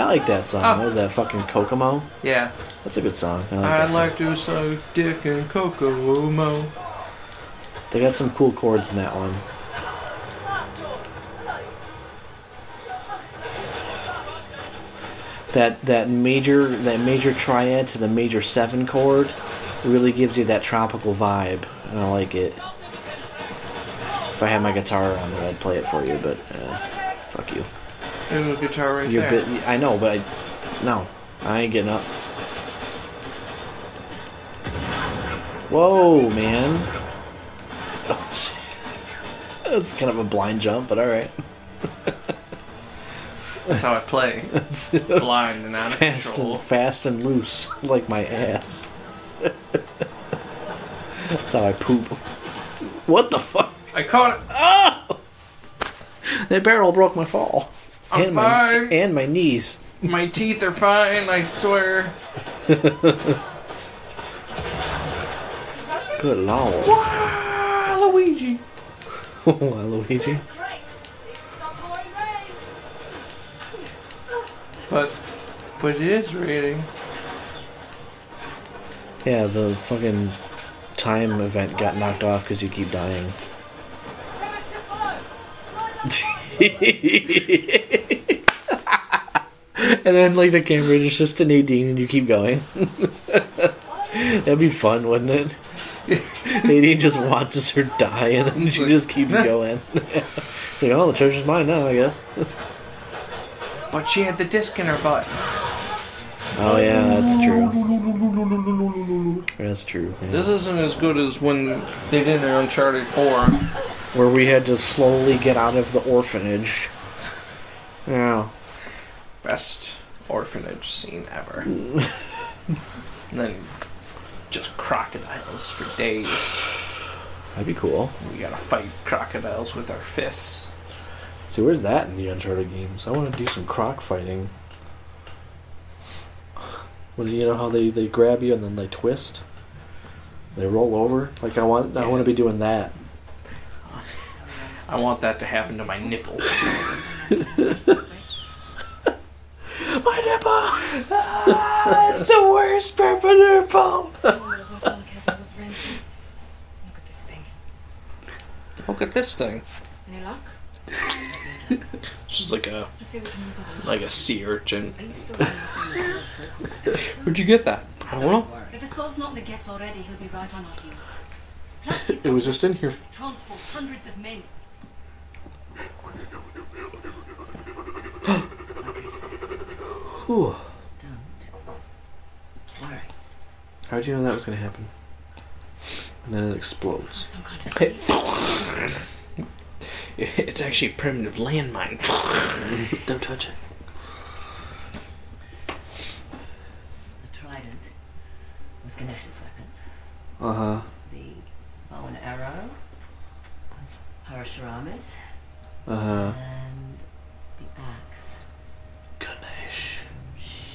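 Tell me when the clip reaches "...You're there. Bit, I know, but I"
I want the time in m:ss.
0:29.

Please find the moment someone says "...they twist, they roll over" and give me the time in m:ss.
2:18.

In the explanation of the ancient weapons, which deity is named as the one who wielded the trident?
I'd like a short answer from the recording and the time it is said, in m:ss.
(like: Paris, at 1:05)
Ganesh, at 3:18.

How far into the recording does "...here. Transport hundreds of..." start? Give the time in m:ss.
2:52.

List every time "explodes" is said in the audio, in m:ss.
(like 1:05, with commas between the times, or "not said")
3:06.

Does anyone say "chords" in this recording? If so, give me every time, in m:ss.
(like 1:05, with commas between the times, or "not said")
0:08, 0:18.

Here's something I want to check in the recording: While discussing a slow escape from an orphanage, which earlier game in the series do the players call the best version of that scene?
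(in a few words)
Uncharted 4.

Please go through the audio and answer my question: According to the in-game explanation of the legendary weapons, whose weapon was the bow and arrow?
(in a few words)
Parashurama.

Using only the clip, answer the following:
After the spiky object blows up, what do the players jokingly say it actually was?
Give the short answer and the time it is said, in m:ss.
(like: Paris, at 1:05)
a primitive landmine, at 3:10.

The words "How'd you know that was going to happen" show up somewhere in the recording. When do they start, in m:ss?
3:03.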